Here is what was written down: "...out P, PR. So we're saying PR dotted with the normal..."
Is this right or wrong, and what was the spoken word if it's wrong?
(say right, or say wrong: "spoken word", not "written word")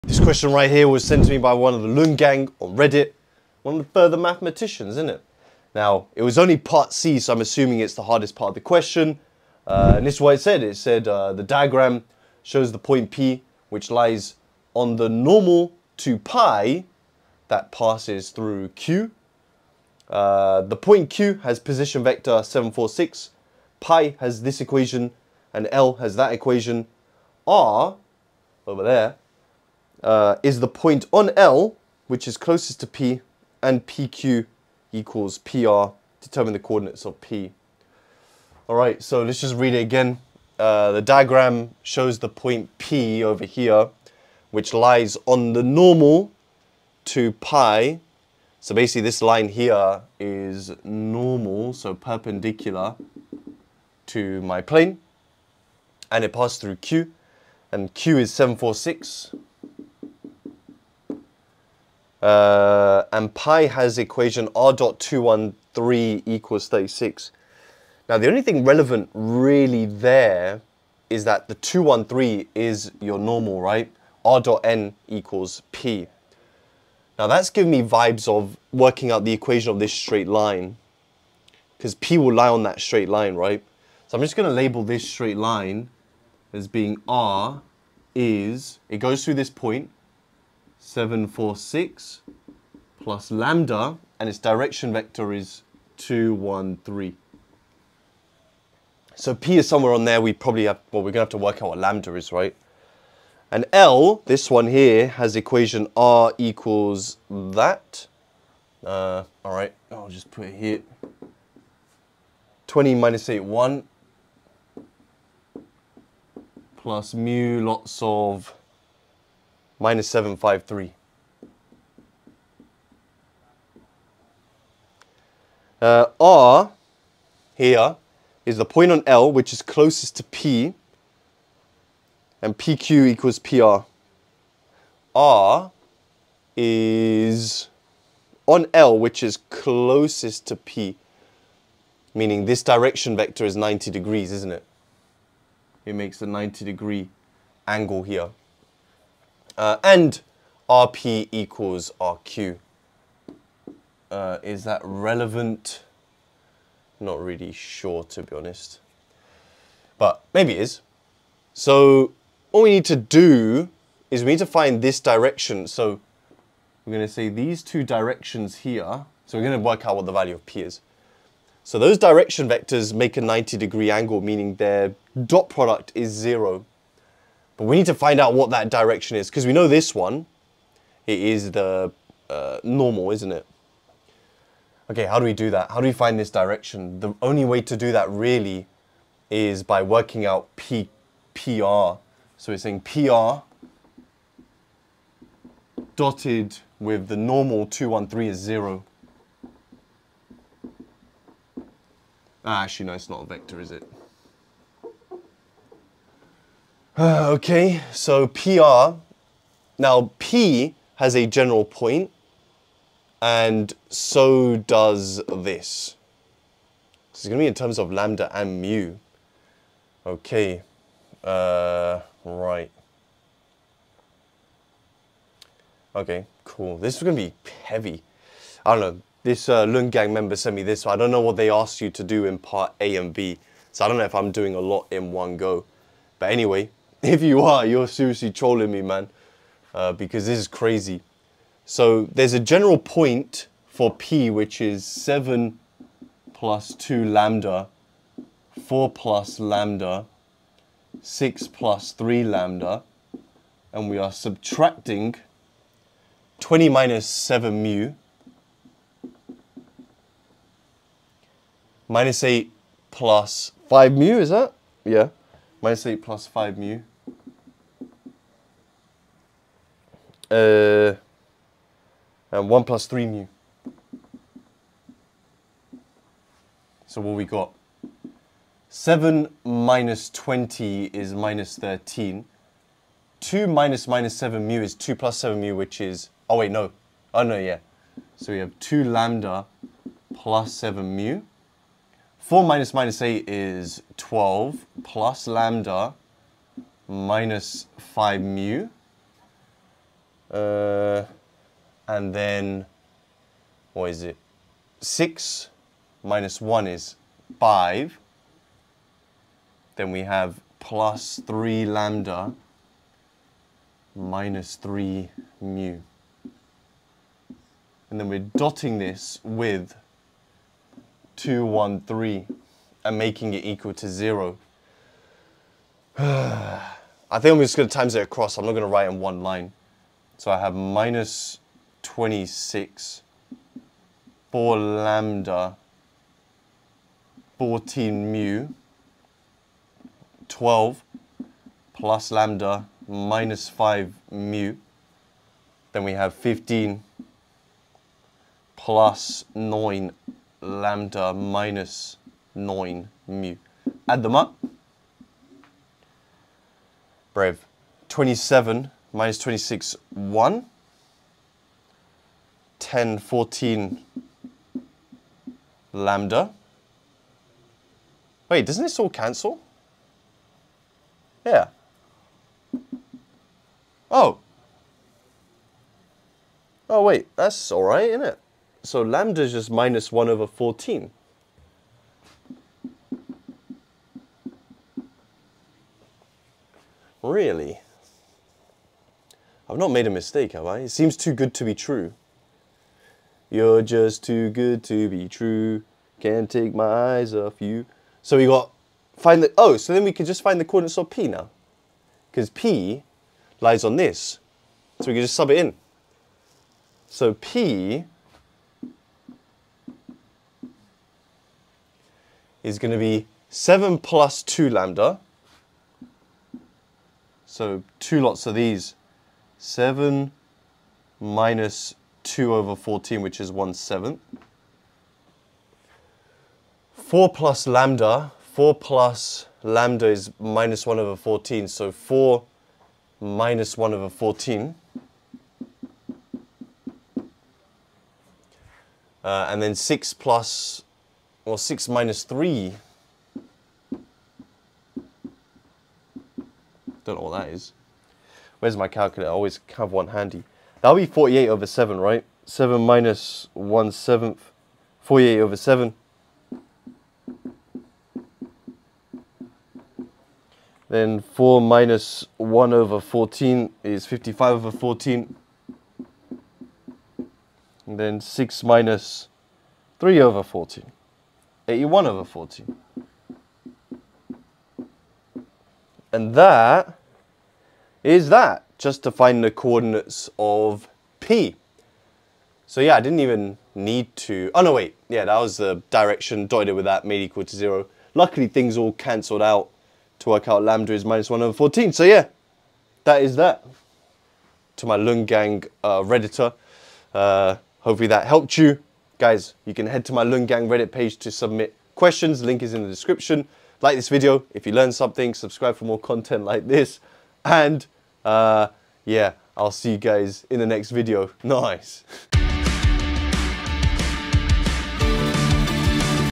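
right.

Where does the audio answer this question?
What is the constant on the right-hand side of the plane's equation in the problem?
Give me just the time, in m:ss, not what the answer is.
1:06.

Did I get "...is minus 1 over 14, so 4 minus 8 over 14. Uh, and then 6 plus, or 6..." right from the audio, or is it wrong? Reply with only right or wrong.
wrong.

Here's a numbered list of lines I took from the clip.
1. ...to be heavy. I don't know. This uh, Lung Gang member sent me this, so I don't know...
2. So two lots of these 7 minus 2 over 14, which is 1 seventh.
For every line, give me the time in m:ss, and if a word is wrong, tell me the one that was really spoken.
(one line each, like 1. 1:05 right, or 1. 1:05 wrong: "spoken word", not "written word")
1. 3:47 right
2. 6:57 right.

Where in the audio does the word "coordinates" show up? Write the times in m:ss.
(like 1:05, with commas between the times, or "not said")
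0:36, 6:40, 7:59.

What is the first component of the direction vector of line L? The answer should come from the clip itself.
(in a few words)
-7.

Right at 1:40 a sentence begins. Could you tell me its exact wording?
We probably have, well, we're going to have to work out what lambda is, right?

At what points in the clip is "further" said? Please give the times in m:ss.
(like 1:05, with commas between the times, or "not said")
0:03.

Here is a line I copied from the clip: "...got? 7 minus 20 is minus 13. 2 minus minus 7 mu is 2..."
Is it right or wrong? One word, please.
right.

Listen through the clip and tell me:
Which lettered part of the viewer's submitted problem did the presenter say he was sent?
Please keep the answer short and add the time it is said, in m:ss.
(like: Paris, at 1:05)
Part C, at 0:06.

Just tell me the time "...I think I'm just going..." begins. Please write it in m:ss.
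5:25.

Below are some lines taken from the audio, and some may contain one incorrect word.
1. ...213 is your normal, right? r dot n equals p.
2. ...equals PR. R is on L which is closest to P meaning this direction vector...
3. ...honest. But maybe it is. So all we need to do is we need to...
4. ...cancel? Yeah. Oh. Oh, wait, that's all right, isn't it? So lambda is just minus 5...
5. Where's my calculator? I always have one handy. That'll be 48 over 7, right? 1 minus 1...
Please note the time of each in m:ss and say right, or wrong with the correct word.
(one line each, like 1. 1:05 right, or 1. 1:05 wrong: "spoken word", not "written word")
1. 1:11 right
2. 2:13 right
3. 2:38 right
4. 6:08 wrong: "1", not "5"
5. 7:28 wrong: "7", not "1".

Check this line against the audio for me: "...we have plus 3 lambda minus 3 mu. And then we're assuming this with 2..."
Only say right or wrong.
wrong.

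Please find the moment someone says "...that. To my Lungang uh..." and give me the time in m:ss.
8:13.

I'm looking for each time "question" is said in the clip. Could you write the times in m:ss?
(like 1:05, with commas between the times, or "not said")
0:00, 0:08, 8:21.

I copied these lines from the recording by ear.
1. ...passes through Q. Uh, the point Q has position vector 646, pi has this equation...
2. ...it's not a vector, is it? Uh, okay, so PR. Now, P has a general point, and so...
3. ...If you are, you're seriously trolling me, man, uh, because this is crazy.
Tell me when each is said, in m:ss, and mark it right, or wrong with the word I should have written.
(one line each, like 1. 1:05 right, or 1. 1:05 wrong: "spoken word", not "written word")
1. 0:17 wrong: "746", not "646"
2. 3:22 right
3. 3:57 right.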